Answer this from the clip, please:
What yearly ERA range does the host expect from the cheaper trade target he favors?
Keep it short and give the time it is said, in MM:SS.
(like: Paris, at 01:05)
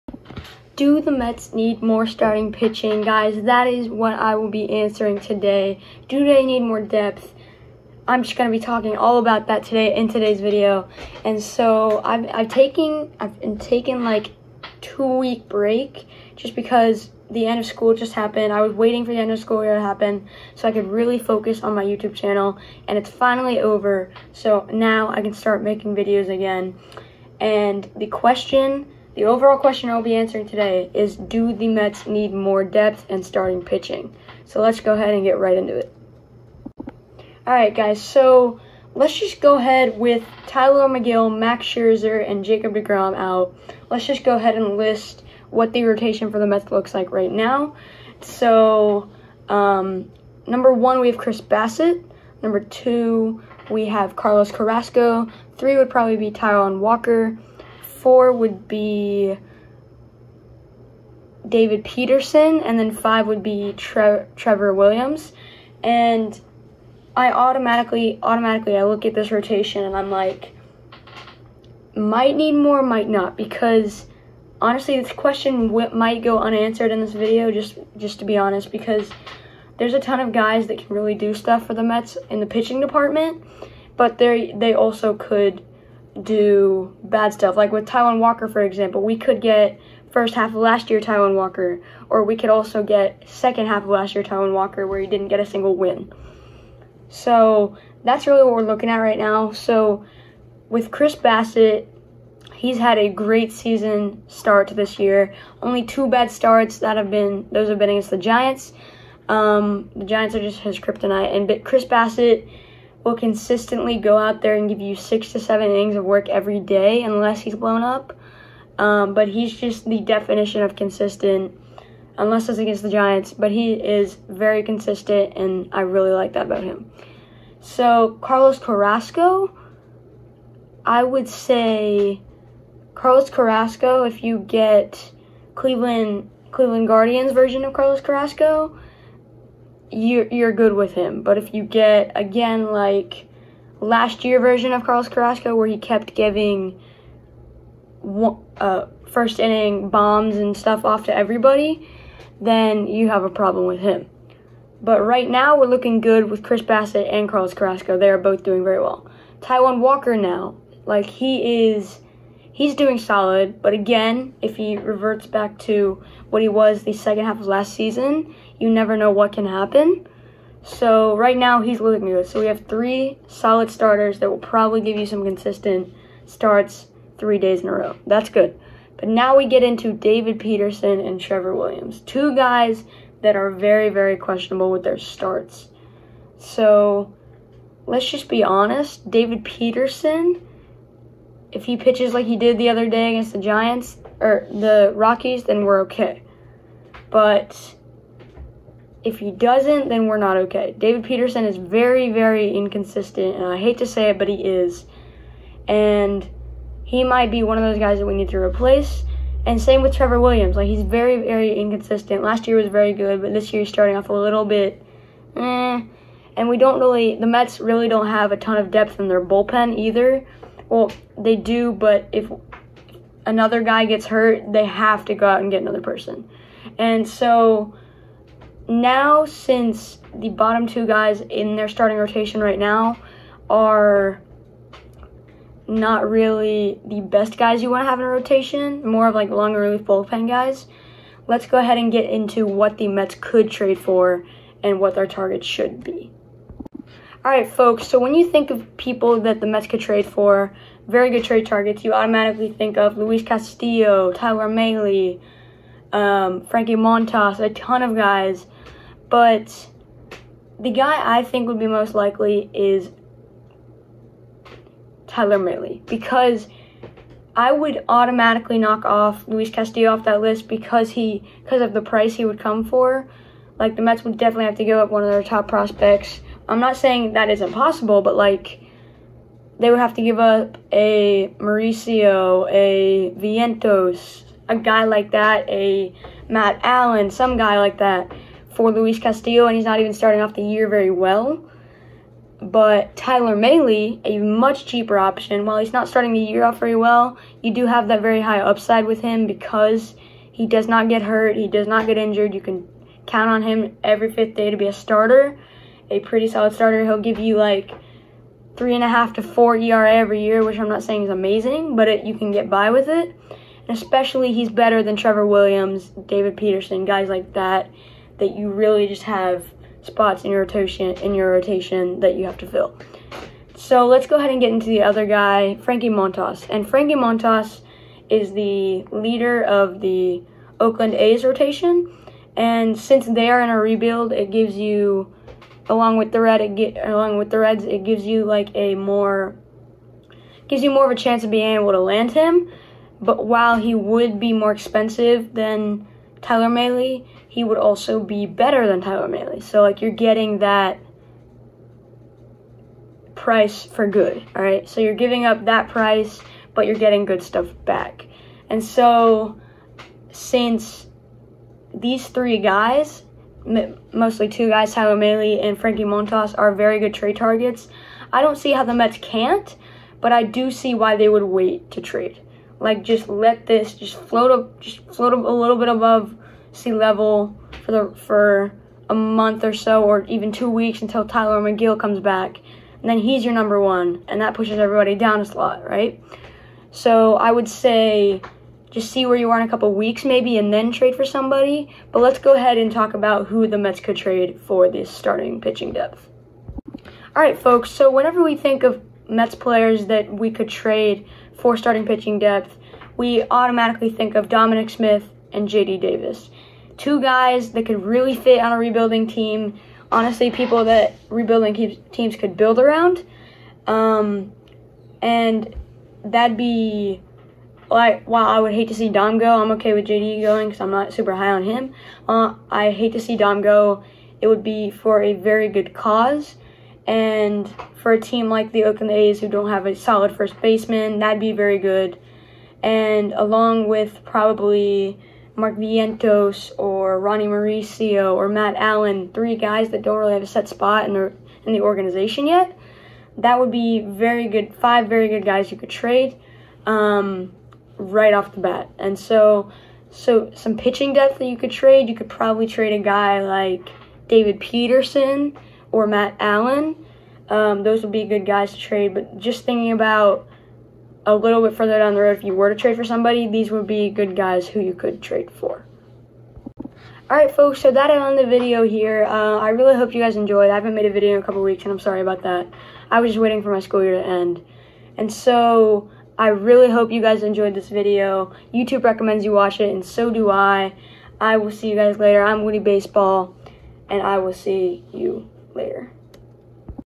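3.5 to 4, at 05:08.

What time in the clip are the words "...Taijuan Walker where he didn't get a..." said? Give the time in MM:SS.
01:34.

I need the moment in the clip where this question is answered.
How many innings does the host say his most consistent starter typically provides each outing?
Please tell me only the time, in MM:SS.
01:54.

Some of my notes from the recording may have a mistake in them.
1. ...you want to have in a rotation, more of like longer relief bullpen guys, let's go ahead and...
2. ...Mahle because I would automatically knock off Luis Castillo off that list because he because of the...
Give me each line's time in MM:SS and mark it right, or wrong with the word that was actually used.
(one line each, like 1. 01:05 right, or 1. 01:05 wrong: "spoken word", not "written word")
1. 03:57 right
2. 04:25 right.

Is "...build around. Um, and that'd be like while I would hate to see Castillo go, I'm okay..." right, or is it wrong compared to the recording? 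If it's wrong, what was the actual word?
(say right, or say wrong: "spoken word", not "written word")
wrong: "Dom", not "Castillo".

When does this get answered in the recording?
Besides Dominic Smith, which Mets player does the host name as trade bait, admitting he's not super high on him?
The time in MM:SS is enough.
06:45.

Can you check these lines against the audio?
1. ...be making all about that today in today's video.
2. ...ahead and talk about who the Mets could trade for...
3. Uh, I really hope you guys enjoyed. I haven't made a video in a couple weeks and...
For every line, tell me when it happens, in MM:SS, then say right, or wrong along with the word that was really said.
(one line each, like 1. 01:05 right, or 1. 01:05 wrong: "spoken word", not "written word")
1. 00:08 wrong: "talking", not "making"
2. 06:32 right
3. 07:49 right.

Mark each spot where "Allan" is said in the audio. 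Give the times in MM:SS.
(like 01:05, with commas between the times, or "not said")
04:46, 07:18, 07:36.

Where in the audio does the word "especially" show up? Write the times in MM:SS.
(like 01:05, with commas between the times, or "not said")
05:13.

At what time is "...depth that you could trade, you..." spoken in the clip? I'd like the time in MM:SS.
07:30.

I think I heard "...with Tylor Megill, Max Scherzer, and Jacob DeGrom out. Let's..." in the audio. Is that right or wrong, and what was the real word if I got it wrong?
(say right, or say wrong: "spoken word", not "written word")
right.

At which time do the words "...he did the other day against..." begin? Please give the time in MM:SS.
03:12.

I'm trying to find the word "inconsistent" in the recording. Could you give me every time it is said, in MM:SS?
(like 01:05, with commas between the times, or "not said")
03:22, 03:31.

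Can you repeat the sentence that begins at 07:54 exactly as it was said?
And so I really hope you guys enjoyed this video.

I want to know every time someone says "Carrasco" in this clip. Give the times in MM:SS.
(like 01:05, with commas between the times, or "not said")
00:54, 02:08, 02:13, 02:18, 02:25, 02:37.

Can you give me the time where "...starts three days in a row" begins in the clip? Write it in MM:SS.
02:56.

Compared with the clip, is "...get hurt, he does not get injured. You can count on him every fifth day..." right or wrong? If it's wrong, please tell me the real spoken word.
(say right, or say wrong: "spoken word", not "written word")
right.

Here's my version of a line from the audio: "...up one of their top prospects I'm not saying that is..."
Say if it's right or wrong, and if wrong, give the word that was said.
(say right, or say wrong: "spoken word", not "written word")
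right.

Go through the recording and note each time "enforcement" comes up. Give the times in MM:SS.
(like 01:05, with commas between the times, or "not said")
not said.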